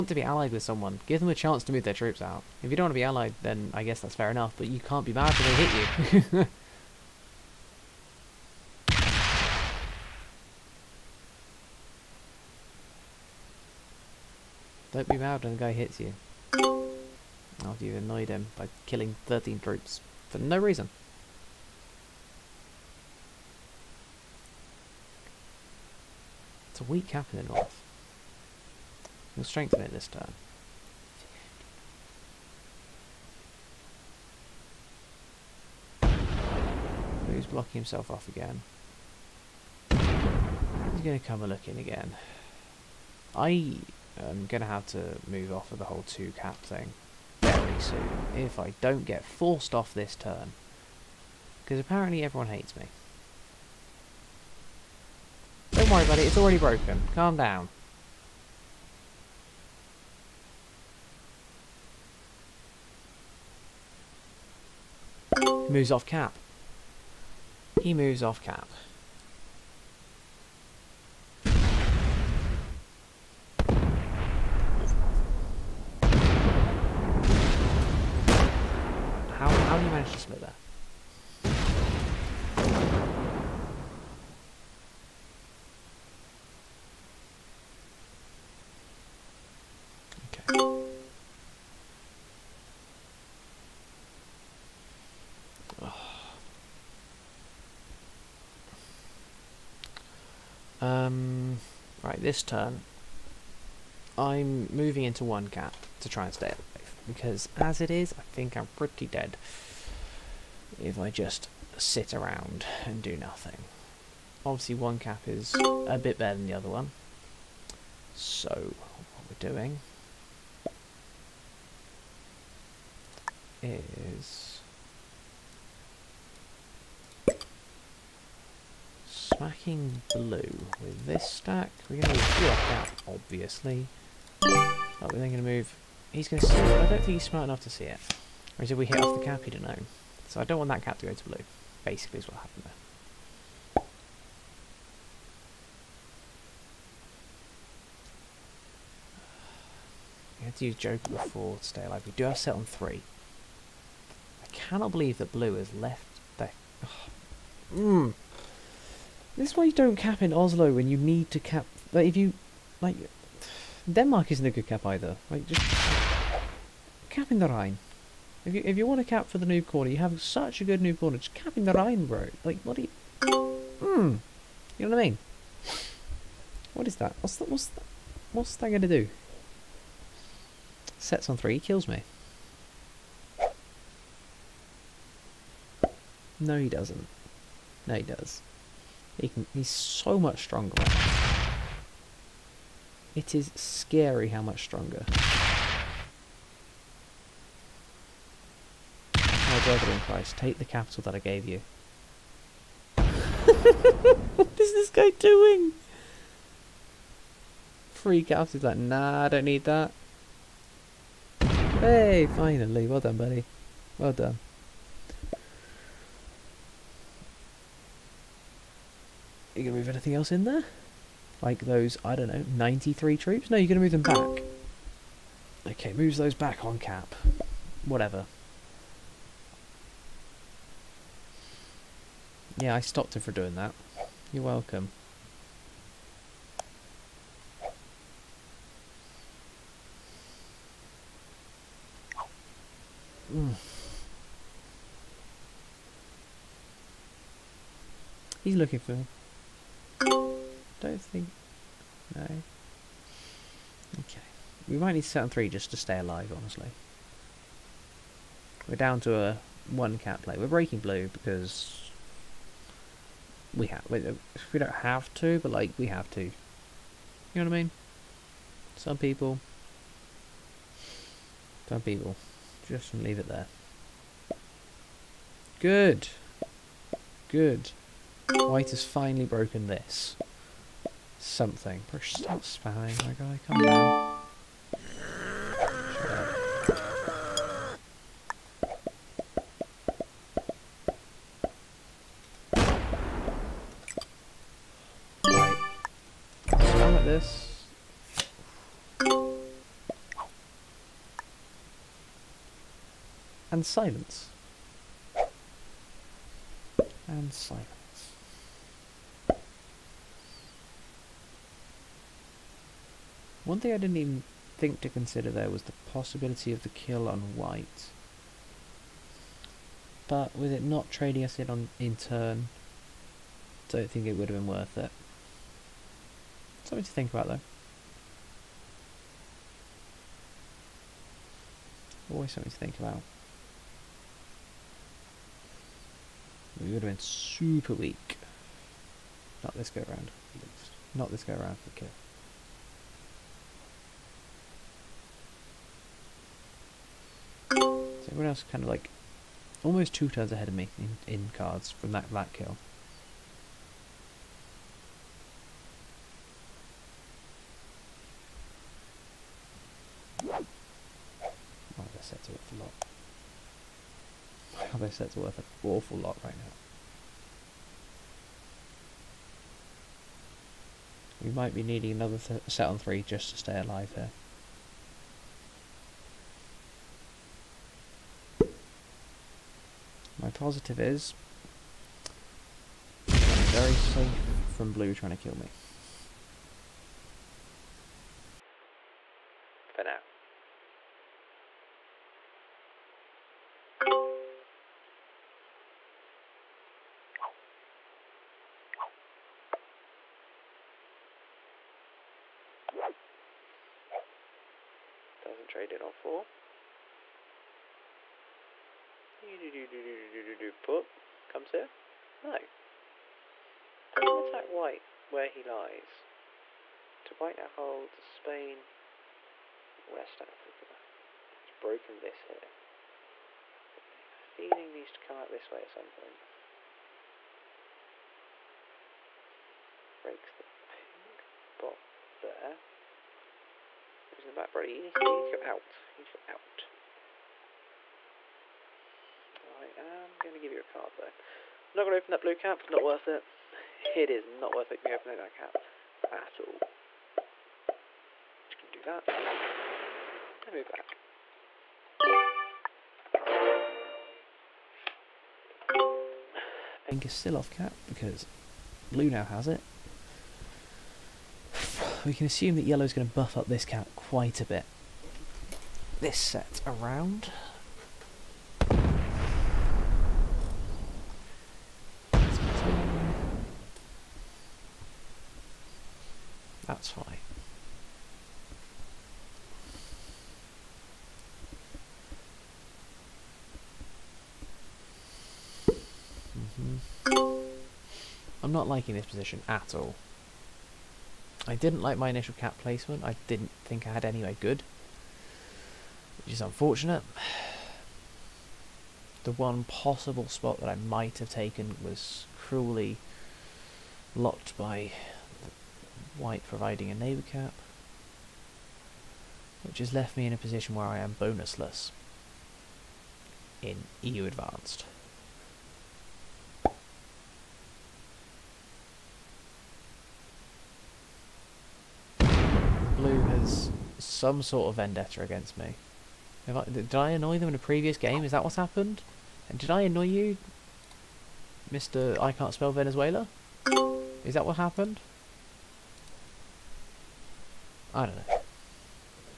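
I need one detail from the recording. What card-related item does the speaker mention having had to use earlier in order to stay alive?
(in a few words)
Joker.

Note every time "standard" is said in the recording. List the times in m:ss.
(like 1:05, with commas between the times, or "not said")
not said.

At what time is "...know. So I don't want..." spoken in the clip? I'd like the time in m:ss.
2:19.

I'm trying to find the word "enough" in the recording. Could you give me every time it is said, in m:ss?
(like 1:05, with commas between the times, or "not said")
0:04, 2:17.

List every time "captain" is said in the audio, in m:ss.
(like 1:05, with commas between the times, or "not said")
not said.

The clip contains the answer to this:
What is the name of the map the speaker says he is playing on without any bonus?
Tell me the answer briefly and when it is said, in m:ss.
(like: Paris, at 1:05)
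EU Advanced, at 8:34.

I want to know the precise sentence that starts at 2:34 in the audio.
I cannot believe that blue is left there.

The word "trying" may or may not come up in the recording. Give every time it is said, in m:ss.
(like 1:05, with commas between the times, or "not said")
6:24.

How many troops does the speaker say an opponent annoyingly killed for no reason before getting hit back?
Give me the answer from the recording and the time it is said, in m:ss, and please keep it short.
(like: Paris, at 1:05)
13, at 0:19.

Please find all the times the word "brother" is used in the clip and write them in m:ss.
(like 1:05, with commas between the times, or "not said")
3:19, 7:14.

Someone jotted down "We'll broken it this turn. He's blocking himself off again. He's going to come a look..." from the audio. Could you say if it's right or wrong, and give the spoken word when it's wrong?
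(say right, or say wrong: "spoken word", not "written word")
wrong: "strengthen", not "broken".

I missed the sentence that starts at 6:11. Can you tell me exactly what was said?
We might be needing another set on three just to stay alive here.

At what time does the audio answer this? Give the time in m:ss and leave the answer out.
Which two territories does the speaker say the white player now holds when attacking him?
6:58.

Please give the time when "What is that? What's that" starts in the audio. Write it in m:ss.
2:56.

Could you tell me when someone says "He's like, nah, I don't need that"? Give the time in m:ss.
3:28.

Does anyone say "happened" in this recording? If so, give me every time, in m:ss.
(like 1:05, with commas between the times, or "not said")
2:22, 8:48, 8:54.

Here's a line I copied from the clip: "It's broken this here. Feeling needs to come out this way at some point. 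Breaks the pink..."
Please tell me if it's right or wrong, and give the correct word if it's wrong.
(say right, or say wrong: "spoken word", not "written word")
right.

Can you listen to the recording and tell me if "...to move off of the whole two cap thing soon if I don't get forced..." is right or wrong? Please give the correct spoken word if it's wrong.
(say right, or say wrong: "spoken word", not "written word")
right.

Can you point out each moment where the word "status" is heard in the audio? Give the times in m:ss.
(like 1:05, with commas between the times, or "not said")
not said.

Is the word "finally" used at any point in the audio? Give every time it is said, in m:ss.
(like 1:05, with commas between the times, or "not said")
3:32, 4:38.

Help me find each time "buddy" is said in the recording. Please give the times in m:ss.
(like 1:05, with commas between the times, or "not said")
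3:33.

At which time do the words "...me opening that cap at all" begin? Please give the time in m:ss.
7:24.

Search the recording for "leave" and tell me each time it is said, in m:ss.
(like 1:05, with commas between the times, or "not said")
4:32.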